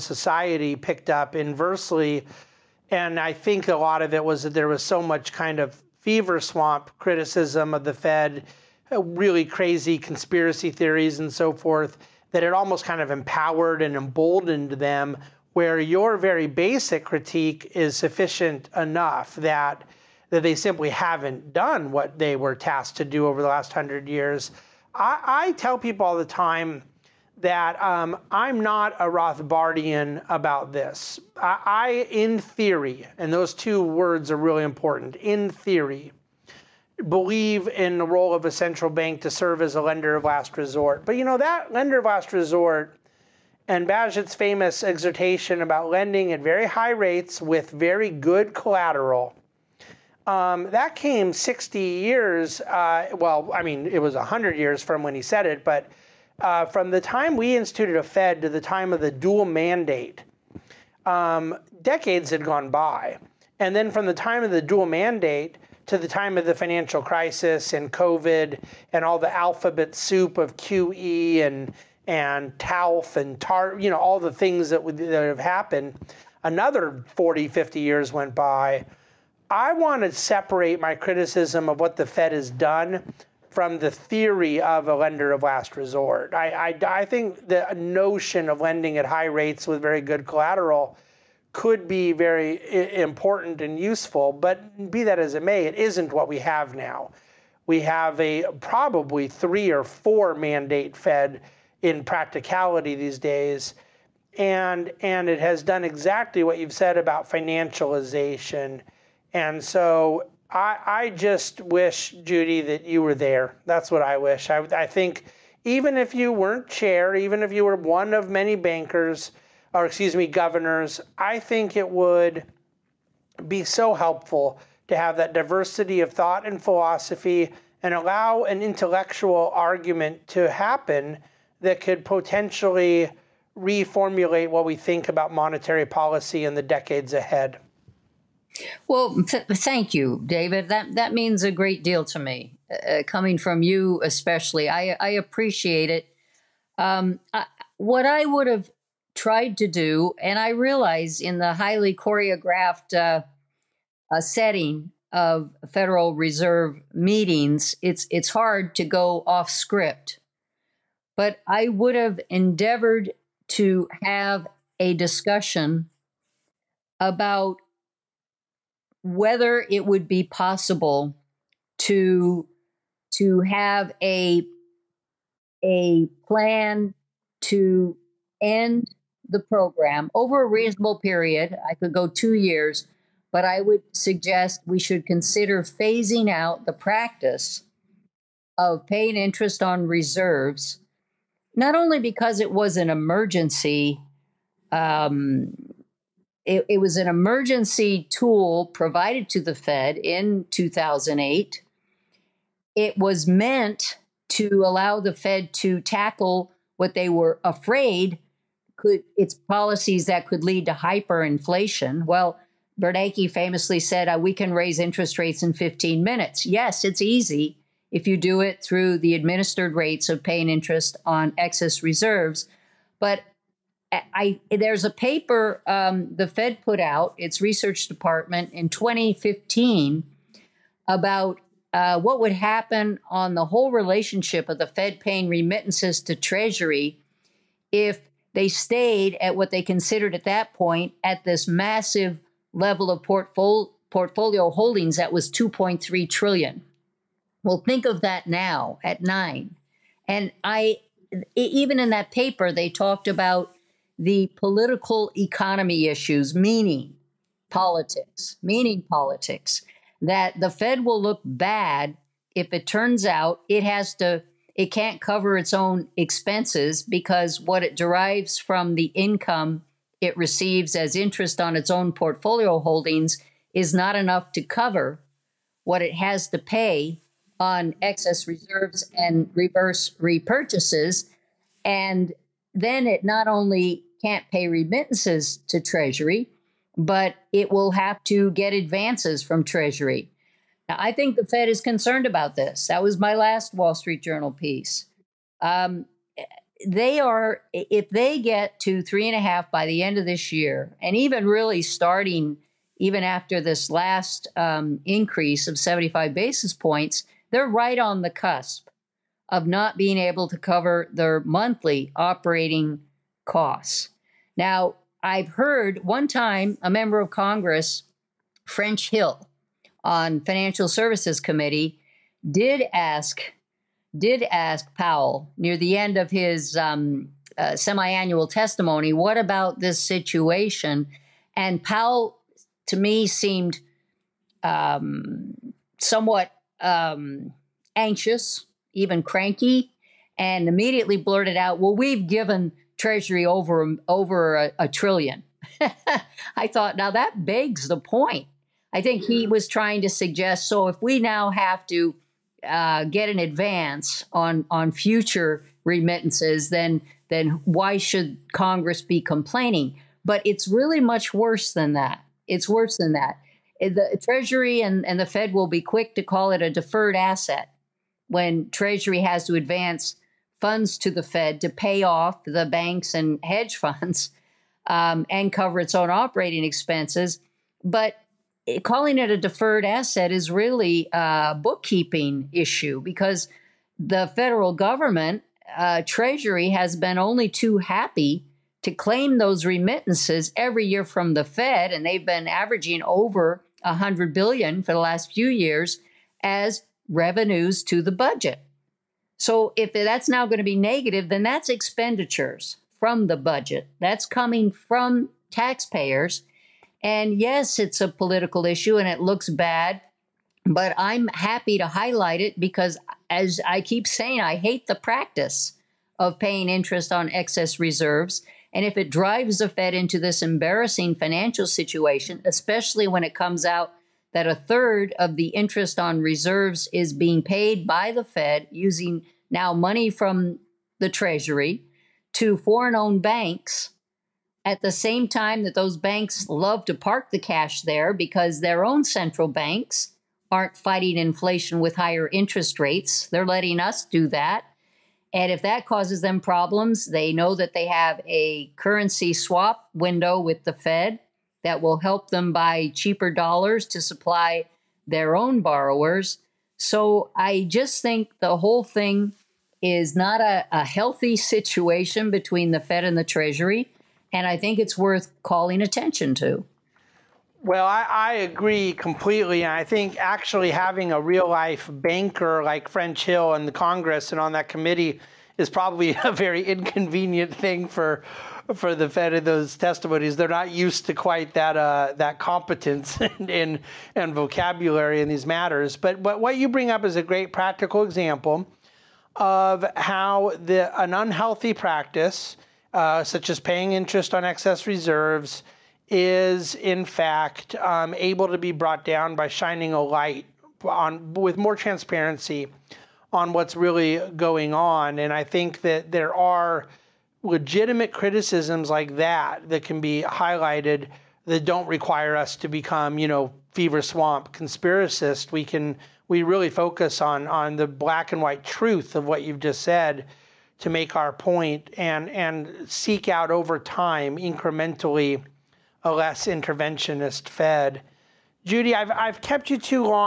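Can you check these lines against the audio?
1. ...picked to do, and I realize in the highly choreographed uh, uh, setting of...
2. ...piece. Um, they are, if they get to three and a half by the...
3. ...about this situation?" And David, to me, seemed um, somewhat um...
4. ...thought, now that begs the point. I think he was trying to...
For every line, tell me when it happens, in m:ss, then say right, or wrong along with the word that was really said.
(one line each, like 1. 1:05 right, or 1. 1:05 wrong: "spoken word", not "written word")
1. 2:29 wrong: "tried", not "picked"
2. 4:54 right
3. 5:29 wrong: "Powell", not "David"
4. 5:46 right.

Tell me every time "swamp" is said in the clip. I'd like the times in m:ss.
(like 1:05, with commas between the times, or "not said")
0:06, 8:33.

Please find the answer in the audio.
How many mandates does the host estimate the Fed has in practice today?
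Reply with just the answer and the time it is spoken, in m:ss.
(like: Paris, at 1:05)
three or four, at 1:39.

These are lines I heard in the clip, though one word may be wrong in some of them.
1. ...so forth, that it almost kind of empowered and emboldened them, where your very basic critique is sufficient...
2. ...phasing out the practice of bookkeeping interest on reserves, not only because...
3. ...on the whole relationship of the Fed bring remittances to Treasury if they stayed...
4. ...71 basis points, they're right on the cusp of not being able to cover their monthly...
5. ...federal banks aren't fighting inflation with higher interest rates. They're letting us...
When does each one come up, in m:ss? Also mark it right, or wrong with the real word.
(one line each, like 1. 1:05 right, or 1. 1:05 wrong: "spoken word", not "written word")
1. 0:11 right
2. 3:05 wrong: "paying", not "bookkeeping"
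3. 3:53 wrong: "paying", not "bring"
4. 5:05 wrong: "75", not "71"
5. 7:18 wrong: "central", not "federal".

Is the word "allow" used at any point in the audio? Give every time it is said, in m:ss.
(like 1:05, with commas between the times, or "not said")
2:07, 3:24.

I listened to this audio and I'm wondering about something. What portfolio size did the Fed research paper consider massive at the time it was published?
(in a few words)
2.3 trillion.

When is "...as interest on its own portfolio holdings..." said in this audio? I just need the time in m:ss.
4:30.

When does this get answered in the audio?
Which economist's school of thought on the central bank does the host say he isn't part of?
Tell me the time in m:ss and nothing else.
0:29.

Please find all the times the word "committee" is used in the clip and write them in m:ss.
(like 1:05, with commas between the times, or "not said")
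5:21, 7:54.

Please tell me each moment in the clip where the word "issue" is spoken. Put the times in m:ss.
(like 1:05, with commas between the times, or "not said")
4:15, 6:22, 6:48.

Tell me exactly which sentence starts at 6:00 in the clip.
But it's really much worse than that.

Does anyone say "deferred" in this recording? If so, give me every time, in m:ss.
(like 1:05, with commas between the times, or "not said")
6:06, 6:19.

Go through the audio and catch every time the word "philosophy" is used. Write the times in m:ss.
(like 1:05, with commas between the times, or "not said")
2:06.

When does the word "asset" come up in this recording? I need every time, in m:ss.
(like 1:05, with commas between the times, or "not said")
6:06, 6:19.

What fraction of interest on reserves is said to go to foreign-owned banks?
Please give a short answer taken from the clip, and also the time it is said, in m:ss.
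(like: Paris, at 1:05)
a third, at 7:04.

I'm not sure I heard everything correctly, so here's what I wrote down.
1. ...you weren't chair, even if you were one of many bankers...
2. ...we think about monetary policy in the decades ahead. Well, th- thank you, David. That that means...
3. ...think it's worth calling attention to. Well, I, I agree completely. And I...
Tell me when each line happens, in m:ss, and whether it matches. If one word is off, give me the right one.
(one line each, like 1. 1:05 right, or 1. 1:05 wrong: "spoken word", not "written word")
1. 1:56 right
2. 2:14 right
3. 7:44 right.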